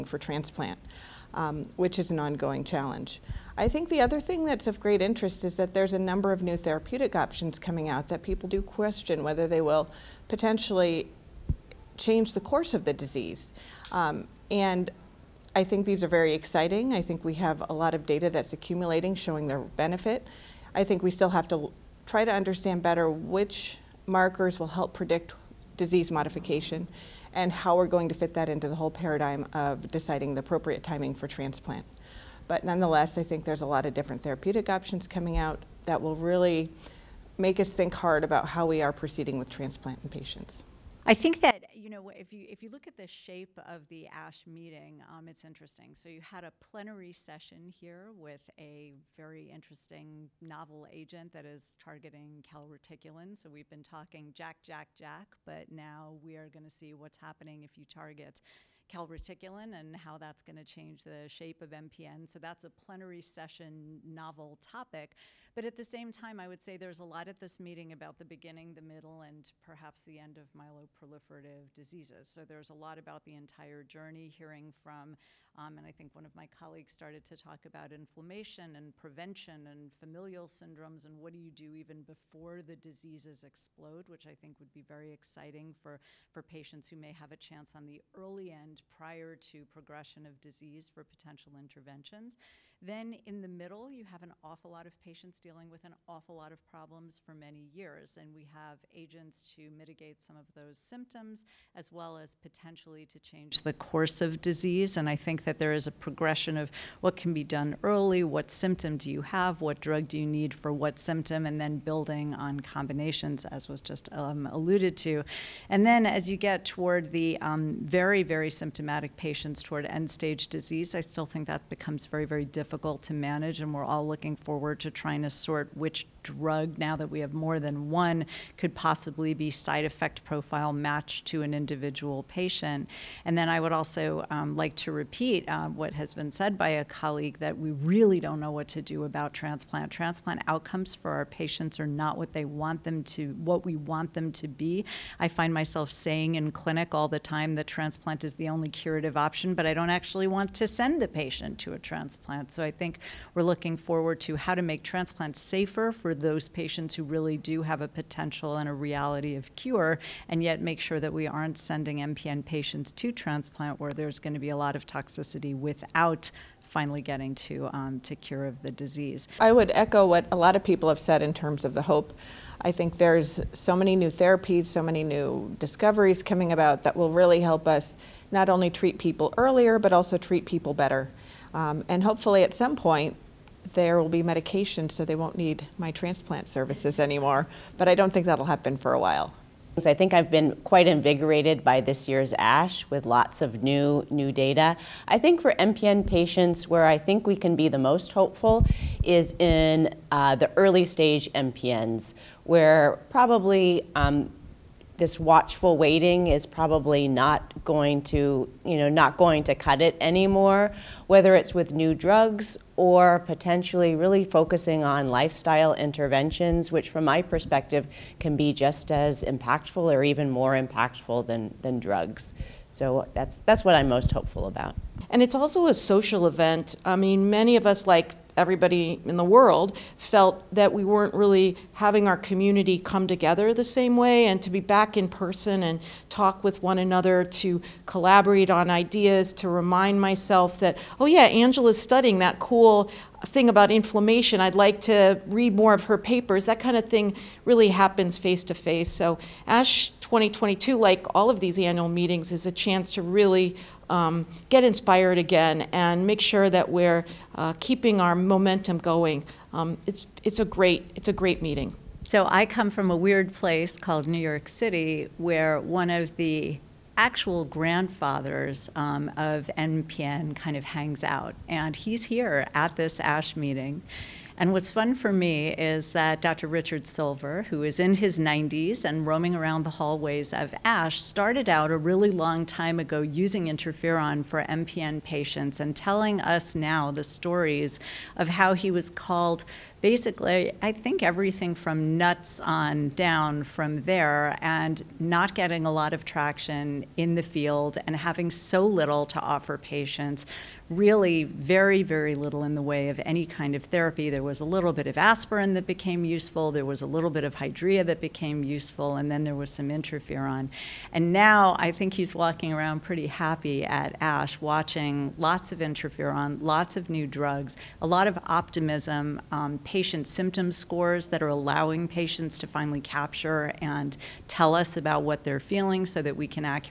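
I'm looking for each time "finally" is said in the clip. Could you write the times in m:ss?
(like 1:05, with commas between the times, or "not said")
2:46, 5:22.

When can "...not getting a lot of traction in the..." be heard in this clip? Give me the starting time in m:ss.
4:54.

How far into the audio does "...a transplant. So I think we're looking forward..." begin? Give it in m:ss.
2:31.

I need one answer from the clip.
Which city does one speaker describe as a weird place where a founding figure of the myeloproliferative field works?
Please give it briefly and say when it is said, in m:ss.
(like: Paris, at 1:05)
New York City, at 4:24.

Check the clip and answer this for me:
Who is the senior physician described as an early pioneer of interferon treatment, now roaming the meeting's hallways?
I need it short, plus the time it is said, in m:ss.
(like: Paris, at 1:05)
Dr. Richard Silver, at 4:36.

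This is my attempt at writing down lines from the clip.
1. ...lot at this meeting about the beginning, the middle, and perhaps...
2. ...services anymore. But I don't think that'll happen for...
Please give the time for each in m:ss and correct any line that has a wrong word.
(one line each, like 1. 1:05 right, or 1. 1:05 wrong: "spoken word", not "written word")
1. 1:07 right
2. 3:06 right.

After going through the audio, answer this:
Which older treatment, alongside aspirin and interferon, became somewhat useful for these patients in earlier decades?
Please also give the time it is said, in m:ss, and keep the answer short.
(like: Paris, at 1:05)
hydrea, at 5:07.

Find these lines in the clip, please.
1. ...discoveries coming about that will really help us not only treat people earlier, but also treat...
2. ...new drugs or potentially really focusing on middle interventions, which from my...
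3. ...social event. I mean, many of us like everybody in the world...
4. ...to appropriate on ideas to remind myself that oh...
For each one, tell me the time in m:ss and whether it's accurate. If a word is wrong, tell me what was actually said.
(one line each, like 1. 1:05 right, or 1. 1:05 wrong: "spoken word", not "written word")
1. 2:55 right
2. 3:31 wrong: "lifestyle", not "middle"
3. 3:45 right
4. 3:57 wrong: "collaborate", not "appropriate".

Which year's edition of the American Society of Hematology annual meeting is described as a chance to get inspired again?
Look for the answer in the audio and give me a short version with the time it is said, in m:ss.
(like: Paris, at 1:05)
2022, at 4:10.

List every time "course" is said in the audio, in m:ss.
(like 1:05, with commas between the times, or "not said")
0:12, 1:43.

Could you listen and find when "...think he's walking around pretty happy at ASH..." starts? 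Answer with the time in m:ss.
5:11.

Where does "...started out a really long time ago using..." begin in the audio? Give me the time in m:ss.
4:41.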